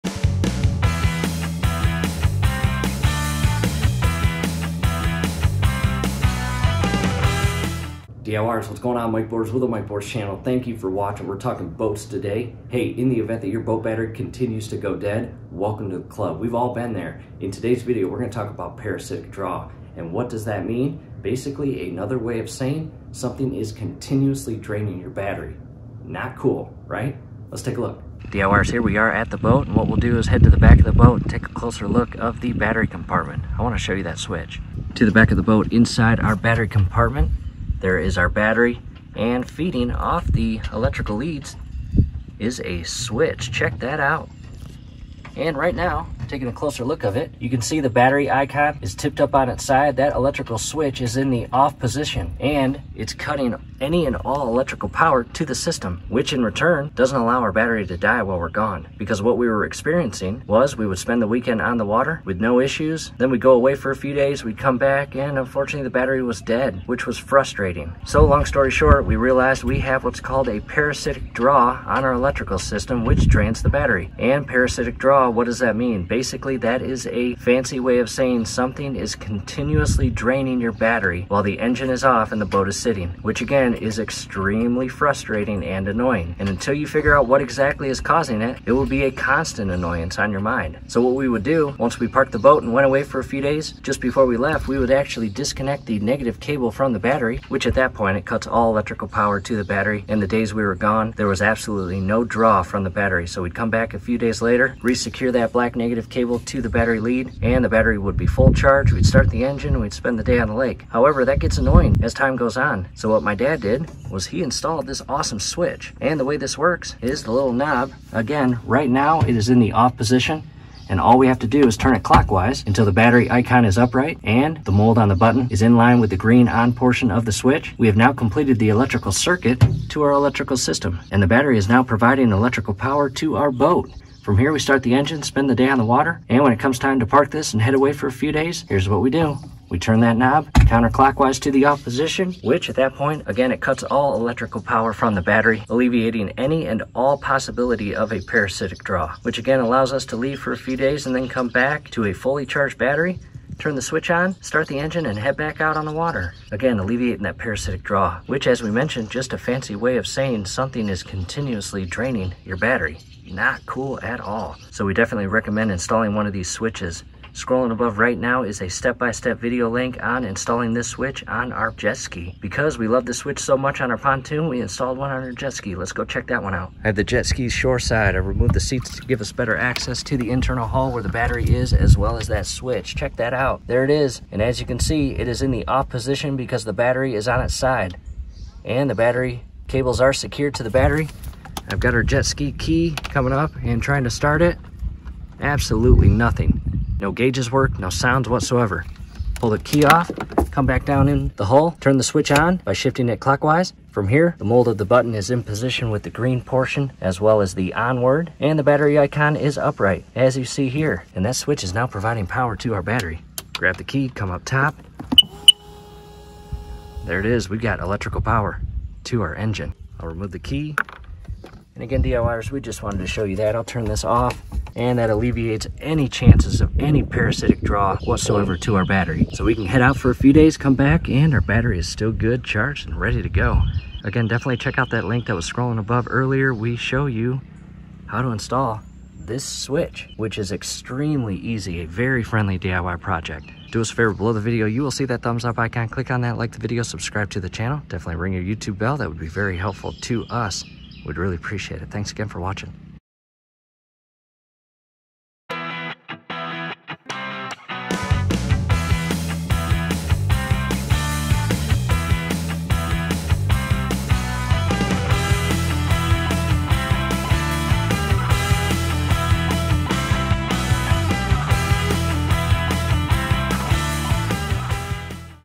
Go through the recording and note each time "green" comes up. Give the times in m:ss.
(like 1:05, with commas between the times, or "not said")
2:06, 3:26.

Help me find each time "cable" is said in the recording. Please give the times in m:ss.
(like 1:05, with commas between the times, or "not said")
1:36, 1:46, 3:09.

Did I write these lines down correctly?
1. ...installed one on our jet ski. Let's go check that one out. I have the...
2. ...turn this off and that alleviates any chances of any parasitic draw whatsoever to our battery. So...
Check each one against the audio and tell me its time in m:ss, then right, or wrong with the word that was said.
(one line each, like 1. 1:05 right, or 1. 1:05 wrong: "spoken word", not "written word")
1. 2:54 right
2. 3:43 right.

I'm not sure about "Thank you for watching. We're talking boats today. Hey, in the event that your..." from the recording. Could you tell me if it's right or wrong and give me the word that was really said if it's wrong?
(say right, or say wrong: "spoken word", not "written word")
right.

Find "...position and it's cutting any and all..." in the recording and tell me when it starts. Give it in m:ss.
0:51.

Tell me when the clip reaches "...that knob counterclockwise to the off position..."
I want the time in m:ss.
2:20.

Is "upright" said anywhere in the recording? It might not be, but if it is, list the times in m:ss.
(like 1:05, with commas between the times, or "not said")
2:03, 3:29.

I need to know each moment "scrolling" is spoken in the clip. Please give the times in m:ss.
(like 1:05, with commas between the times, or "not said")
2:47, 3:55.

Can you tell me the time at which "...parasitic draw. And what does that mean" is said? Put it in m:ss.
0:18.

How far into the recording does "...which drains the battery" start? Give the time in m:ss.
1:13.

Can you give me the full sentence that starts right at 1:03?
Then we'd go away for a few days, we'd come back and unfortunately the battery was dead, which was frustrating.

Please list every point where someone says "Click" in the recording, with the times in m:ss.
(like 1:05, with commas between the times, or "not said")
4:05.